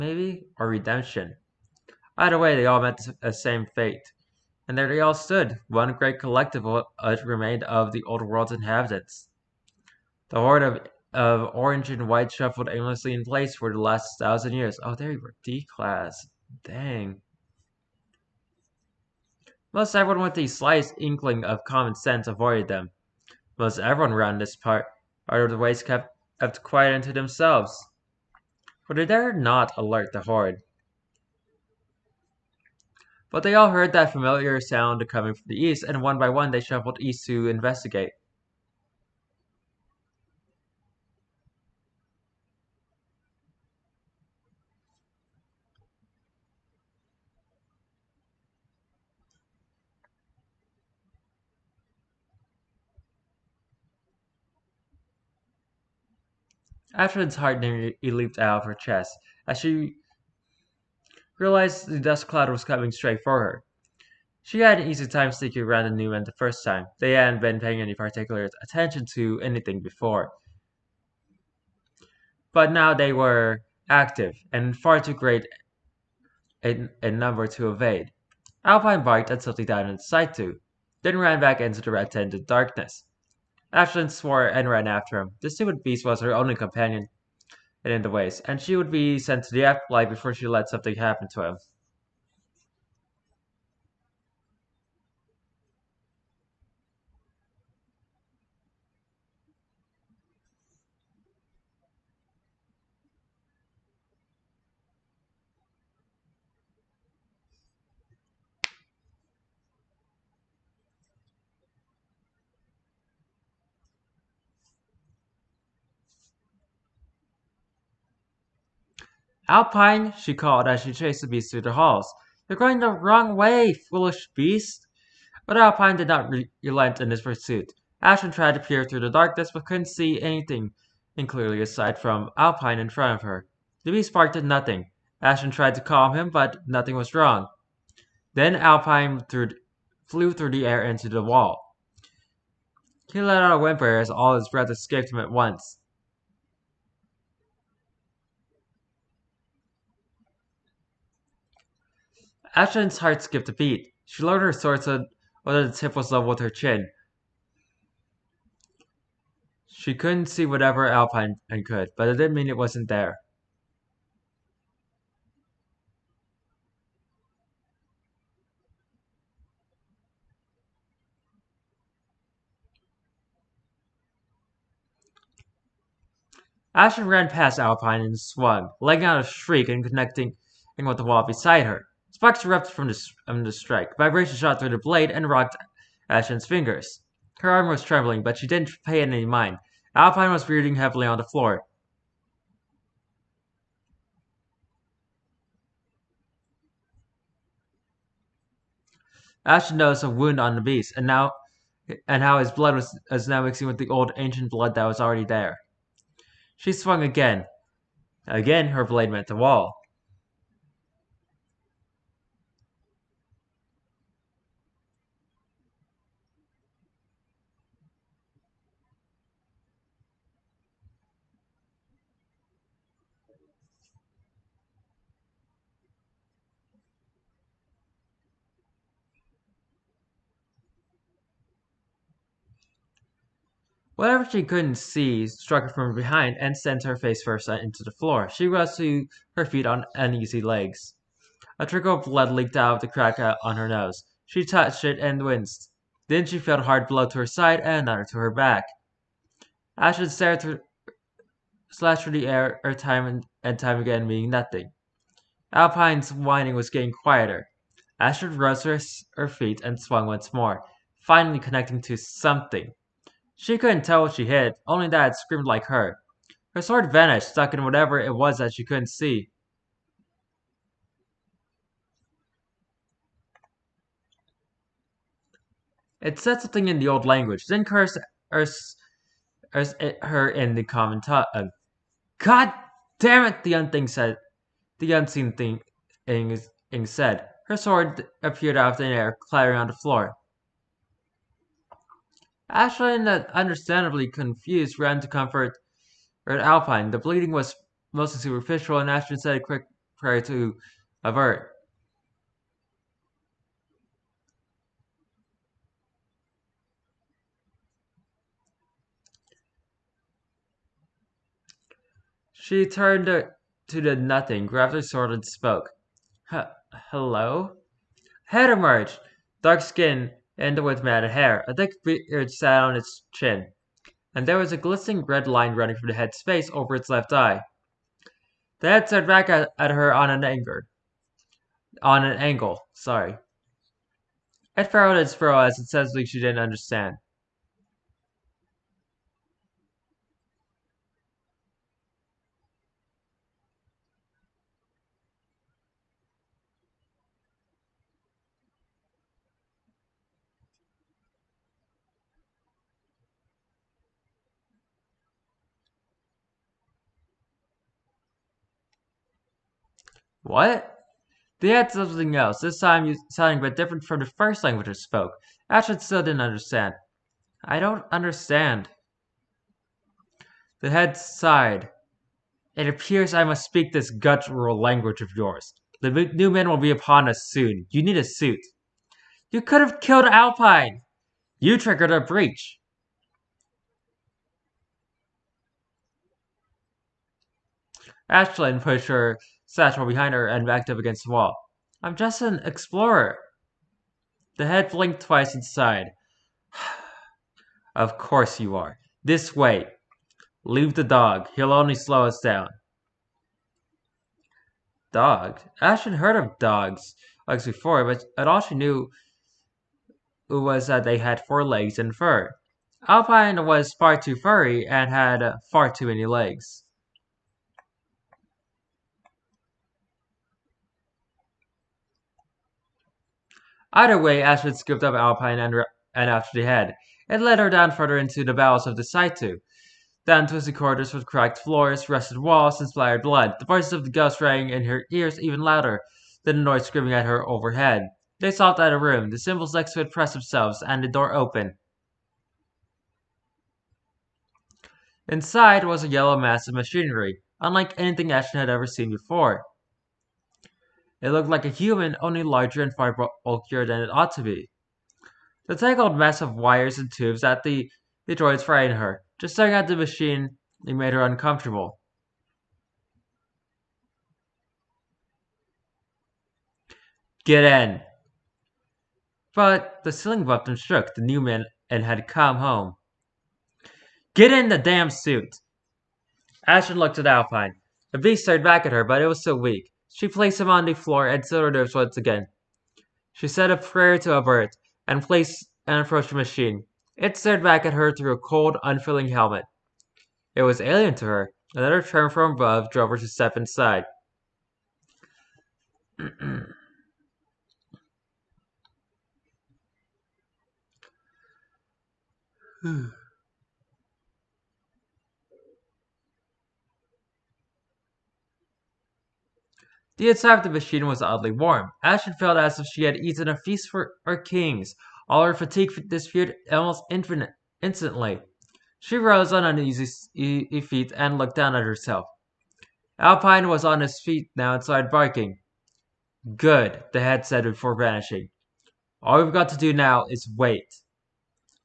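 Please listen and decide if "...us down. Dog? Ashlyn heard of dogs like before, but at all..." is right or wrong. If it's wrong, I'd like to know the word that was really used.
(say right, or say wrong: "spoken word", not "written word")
right.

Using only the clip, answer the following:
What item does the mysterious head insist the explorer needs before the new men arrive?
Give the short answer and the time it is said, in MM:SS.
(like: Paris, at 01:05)
A suit, at 06:17.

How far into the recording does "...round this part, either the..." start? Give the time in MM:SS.
00:24.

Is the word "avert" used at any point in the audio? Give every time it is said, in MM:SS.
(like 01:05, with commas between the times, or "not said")
05:01, 08:04.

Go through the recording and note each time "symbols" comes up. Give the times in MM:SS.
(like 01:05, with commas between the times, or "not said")
07:19.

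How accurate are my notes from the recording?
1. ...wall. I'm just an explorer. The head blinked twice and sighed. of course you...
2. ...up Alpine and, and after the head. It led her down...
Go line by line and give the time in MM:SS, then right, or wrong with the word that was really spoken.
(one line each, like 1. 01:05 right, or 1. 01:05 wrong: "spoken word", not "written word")
1. 06:31 right
2. 07:04 right.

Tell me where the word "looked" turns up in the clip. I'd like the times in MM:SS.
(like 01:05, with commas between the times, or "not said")
07:31, 07:56, 08:41.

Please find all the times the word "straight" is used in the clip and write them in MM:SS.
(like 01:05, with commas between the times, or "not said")
01:02.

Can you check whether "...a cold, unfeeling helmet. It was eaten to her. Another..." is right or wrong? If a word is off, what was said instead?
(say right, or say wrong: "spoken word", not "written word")
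wrong: "alien", not "eaten".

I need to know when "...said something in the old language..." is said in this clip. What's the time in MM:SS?
04:36.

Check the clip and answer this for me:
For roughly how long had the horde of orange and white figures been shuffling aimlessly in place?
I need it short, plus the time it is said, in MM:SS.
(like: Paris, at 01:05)
1000 years, at 00:13.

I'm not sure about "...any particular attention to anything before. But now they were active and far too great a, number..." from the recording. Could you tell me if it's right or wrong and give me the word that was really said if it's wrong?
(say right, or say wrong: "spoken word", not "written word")
right.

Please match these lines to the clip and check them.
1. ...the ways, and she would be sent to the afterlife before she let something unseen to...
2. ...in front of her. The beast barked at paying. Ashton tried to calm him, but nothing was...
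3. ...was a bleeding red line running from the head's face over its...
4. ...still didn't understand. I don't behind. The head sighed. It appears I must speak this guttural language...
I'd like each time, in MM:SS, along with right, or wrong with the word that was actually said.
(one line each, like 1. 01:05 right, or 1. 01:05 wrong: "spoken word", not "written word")
1. 01:28 wrong: "happen", not "unseen"
2. 02:12 wrong: "nothing", not "paying"
3. 05:24 wrong: "glistening", not "bleeding"
4. 06:05 wrong: "understand", not "behind".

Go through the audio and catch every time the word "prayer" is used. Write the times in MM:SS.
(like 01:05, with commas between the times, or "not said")
04:59, 08:03.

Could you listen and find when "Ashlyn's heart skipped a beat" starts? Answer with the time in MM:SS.
02:32.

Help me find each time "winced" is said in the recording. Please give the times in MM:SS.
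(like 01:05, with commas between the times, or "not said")
04:05.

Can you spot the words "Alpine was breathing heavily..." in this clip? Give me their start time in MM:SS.
03:09.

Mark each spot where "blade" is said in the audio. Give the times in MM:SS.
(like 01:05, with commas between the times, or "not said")
03:04, 03:28.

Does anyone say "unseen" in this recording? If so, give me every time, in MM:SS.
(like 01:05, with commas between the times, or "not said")
04:44.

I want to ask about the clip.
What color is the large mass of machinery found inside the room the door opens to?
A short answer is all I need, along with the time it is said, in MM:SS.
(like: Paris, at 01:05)
Yellow, at 07:25.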